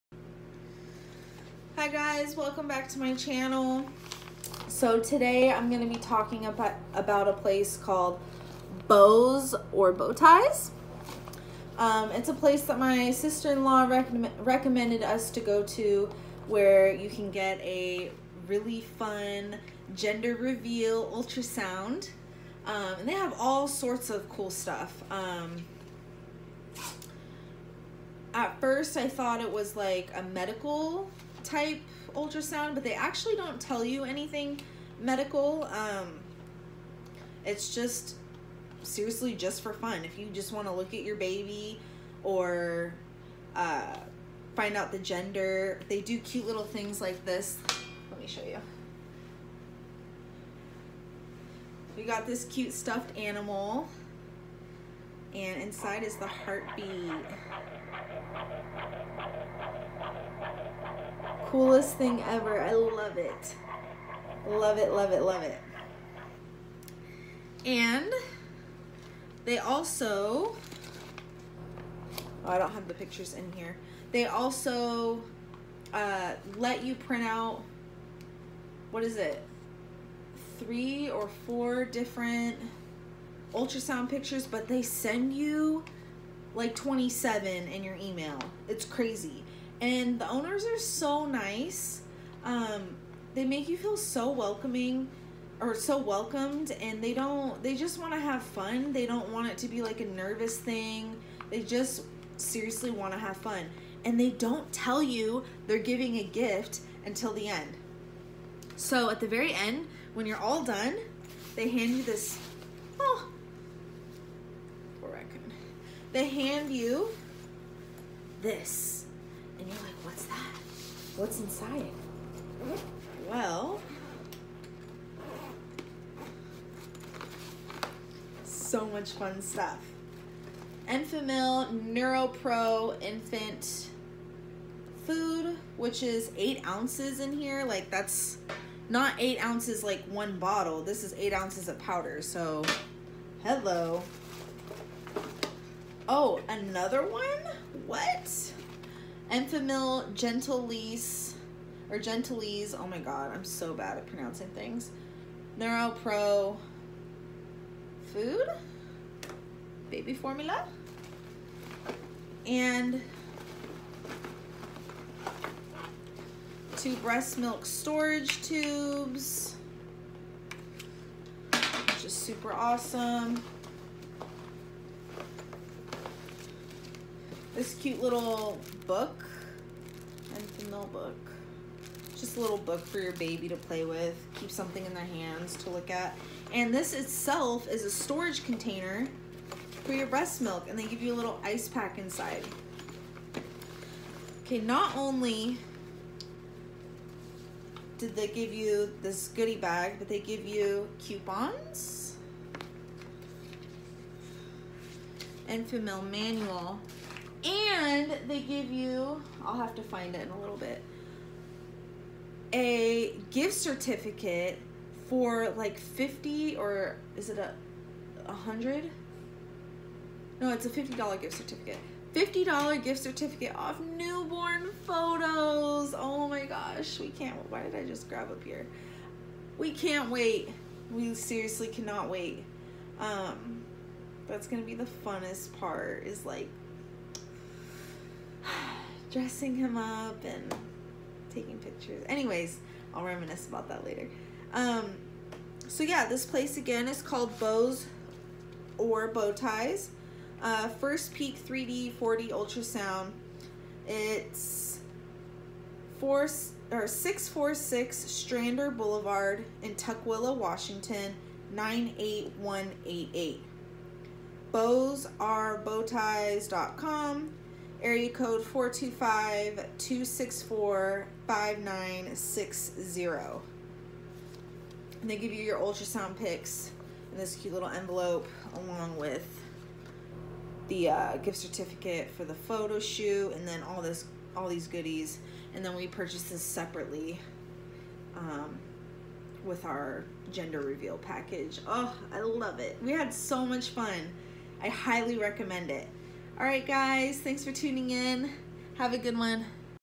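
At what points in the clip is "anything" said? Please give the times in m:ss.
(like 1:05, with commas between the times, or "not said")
0:34.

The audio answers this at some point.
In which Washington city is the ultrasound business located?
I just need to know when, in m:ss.
4:19.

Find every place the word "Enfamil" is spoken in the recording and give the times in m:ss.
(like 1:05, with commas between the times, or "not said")
2:10, 2:29.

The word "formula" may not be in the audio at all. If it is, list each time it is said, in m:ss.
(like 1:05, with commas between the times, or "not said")
2:40.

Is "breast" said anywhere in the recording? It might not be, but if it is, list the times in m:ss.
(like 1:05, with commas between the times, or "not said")
2:46, 3:10.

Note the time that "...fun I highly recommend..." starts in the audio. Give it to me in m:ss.
4:53.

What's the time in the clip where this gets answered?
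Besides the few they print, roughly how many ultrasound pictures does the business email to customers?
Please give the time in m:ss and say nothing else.
1:26.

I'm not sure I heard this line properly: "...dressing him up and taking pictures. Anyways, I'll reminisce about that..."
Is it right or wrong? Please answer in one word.
right.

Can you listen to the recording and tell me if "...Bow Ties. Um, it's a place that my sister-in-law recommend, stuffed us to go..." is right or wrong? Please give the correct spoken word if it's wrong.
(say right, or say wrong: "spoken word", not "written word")
wrong: "recommended", not "stuffed".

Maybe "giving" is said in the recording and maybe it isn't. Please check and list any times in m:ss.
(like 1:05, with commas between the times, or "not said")
1:45.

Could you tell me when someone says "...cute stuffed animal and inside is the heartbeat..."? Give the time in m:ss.
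0:52.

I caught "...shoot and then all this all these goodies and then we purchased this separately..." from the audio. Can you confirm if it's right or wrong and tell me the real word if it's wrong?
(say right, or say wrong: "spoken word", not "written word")
right.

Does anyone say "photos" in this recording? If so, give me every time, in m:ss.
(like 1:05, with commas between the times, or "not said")
3:44, 4:42.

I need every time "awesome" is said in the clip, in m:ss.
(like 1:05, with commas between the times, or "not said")
2:52.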